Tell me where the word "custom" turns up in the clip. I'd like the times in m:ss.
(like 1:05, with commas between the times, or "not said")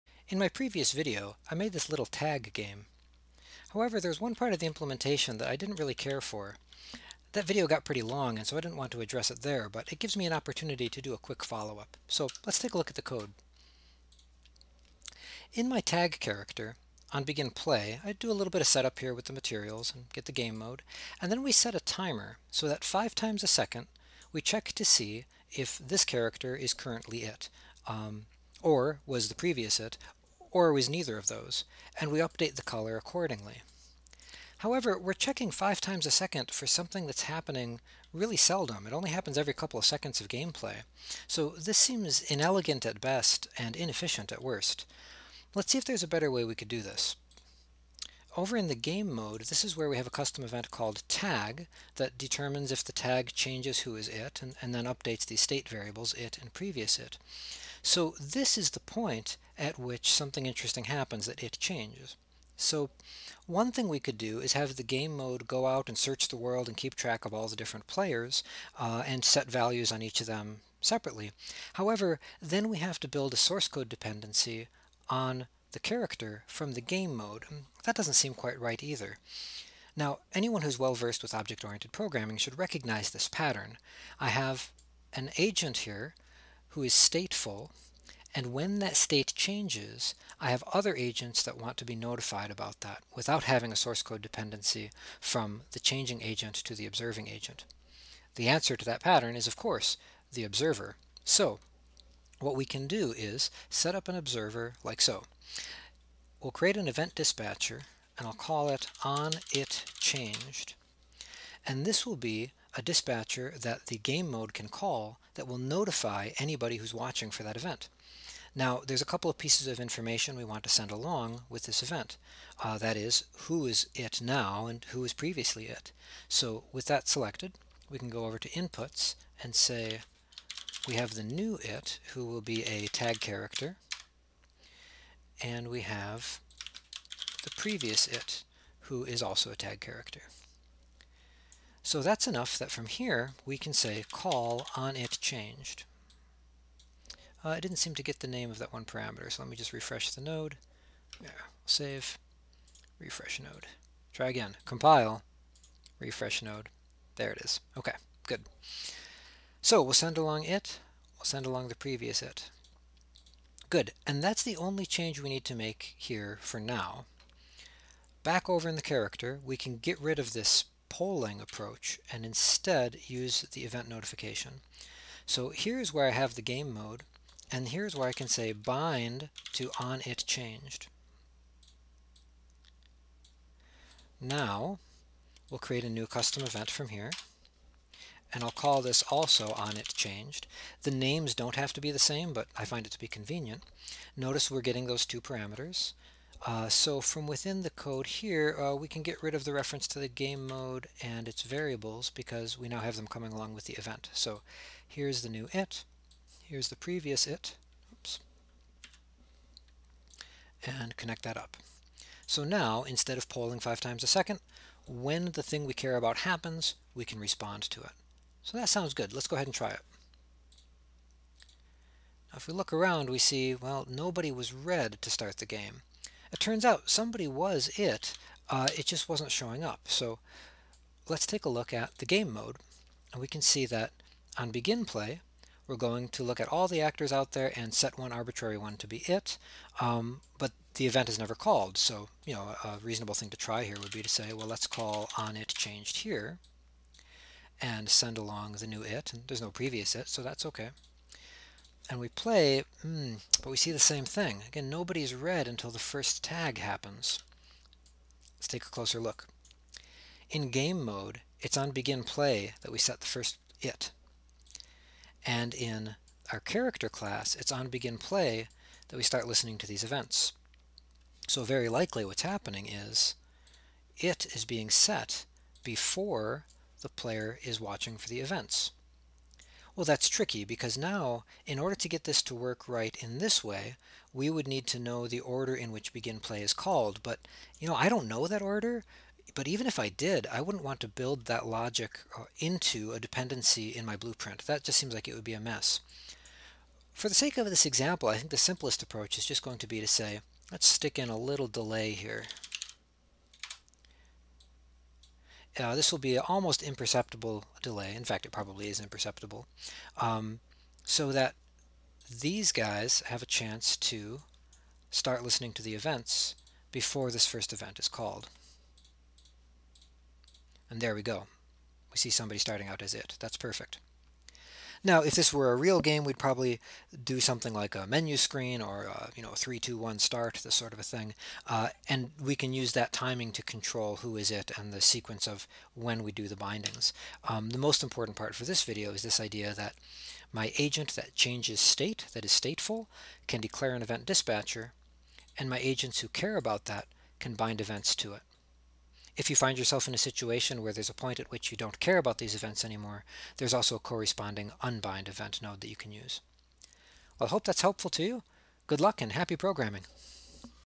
0:50, 3:06.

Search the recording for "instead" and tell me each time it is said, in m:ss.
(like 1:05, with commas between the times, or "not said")
2:52, 3:32.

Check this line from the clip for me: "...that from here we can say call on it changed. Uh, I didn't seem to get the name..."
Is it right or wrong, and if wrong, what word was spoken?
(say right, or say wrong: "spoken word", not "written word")
right.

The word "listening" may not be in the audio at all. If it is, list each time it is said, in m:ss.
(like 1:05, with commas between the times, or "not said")
4:29, 5:15.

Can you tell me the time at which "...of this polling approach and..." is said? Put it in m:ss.
2:50.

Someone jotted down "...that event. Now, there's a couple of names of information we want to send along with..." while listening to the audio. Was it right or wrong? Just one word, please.
wrong.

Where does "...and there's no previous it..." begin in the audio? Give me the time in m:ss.
4:09.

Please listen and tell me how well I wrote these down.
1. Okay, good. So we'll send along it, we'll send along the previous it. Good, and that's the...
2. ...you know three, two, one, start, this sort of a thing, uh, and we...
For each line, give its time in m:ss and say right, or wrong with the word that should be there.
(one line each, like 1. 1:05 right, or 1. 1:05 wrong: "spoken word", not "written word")
1. 2:37 right
2. 5:29 right.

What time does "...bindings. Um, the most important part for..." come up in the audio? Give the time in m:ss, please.
5:36.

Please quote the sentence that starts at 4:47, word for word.
But, you know, I don't know that order.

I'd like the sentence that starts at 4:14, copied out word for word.
Again, nobody's red until the first tag happens.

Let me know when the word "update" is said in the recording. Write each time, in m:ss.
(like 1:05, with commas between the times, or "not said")
0:32, 0:54.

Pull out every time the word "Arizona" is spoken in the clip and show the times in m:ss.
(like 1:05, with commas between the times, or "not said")
not said.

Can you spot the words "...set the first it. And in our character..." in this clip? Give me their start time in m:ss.
4:22.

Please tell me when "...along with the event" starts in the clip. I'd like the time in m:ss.
3:23.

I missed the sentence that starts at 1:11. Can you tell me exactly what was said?
However, then we have to build a source code dependency on the character from the game mode.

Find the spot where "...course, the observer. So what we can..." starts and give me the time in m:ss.
1:39.